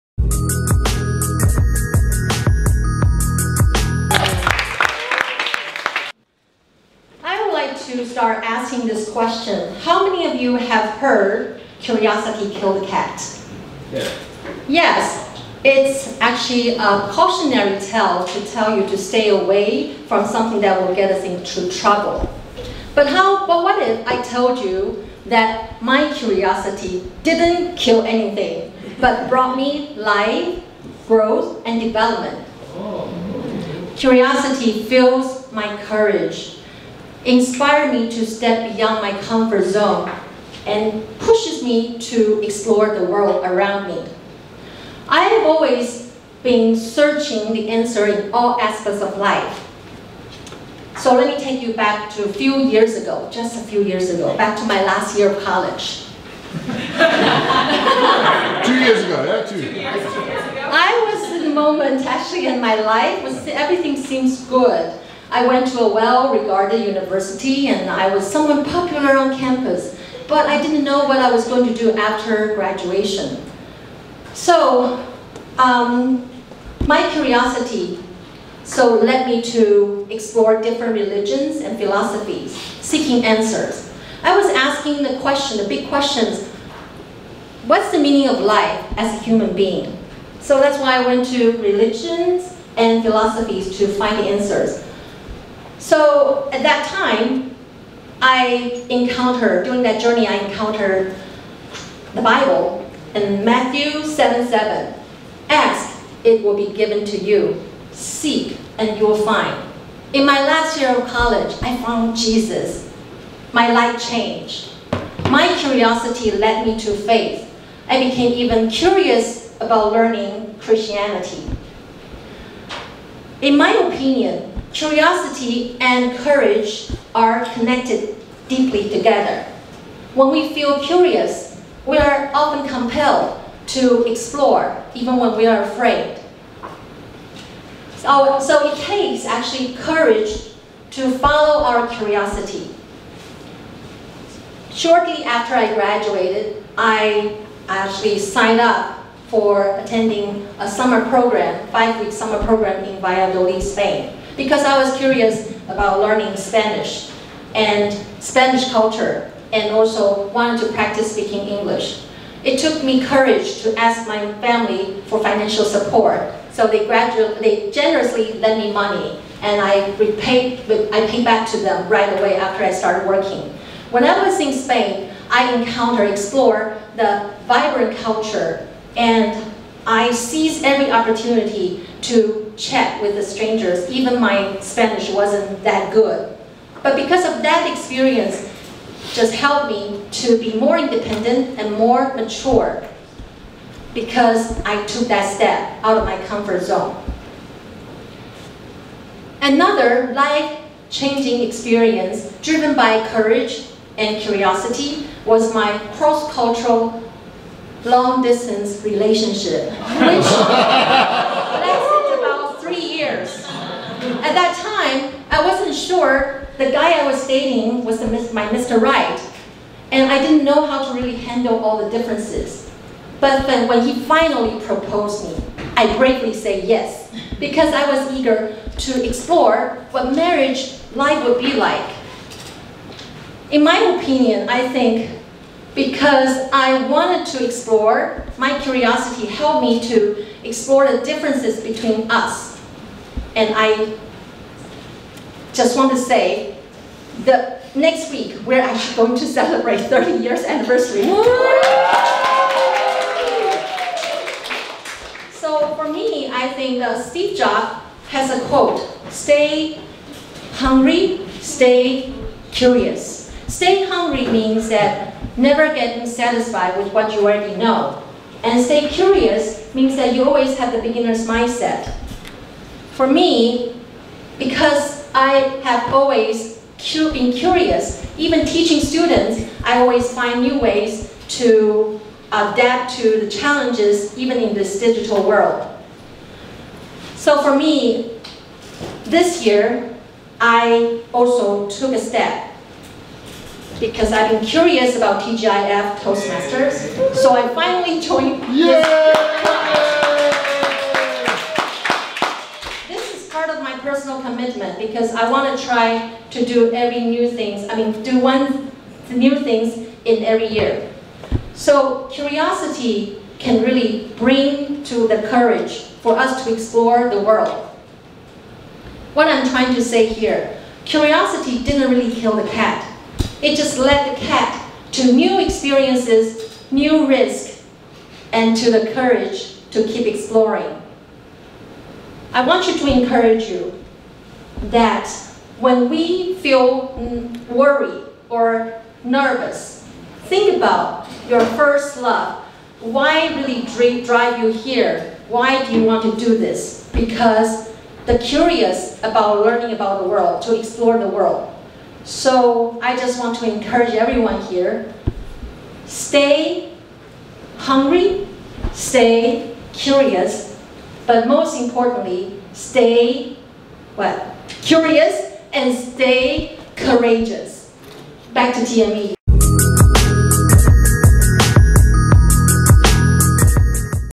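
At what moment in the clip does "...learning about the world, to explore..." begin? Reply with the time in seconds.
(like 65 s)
349 s.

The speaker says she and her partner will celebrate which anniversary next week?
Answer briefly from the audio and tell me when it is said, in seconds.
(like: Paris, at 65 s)
30 years, at 249 s.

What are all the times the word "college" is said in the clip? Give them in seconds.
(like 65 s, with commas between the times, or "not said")
55 s, 111 s.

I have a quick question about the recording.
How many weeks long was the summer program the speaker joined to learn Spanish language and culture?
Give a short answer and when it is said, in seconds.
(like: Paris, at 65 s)
5, at 151 s.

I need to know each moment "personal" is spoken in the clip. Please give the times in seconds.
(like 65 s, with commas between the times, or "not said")
303 s.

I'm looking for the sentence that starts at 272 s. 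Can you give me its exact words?
For me, because I have always been curious.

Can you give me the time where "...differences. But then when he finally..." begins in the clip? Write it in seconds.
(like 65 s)
221 s.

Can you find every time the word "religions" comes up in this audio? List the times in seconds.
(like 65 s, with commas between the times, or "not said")
80 s, 91 s.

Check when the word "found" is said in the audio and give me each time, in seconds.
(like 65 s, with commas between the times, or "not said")
111 s.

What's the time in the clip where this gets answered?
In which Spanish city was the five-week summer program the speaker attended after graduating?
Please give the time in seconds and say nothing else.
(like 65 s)
153 s.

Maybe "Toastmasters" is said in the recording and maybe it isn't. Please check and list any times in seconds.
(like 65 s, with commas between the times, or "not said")
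295 s.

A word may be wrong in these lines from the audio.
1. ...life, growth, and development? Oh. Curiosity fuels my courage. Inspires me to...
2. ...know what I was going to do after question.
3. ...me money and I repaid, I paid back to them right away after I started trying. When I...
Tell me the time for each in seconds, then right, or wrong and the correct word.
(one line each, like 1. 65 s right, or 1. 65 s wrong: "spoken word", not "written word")
1. 29 s right
2. 70 s wrong: "graduation", not "question"
3. 168 s wrong: "working", not "trying".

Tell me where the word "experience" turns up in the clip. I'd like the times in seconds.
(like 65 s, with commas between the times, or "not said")
187 s, 201 s, 325 s.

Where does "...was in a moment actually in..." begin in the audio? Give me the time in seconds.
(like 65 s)
61 s.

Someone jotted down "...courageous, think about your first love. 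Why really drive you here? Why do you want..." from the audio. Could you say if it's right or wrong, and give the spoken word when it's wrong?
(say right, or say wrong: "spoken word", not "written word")
wrong: "nervous", not "courageous".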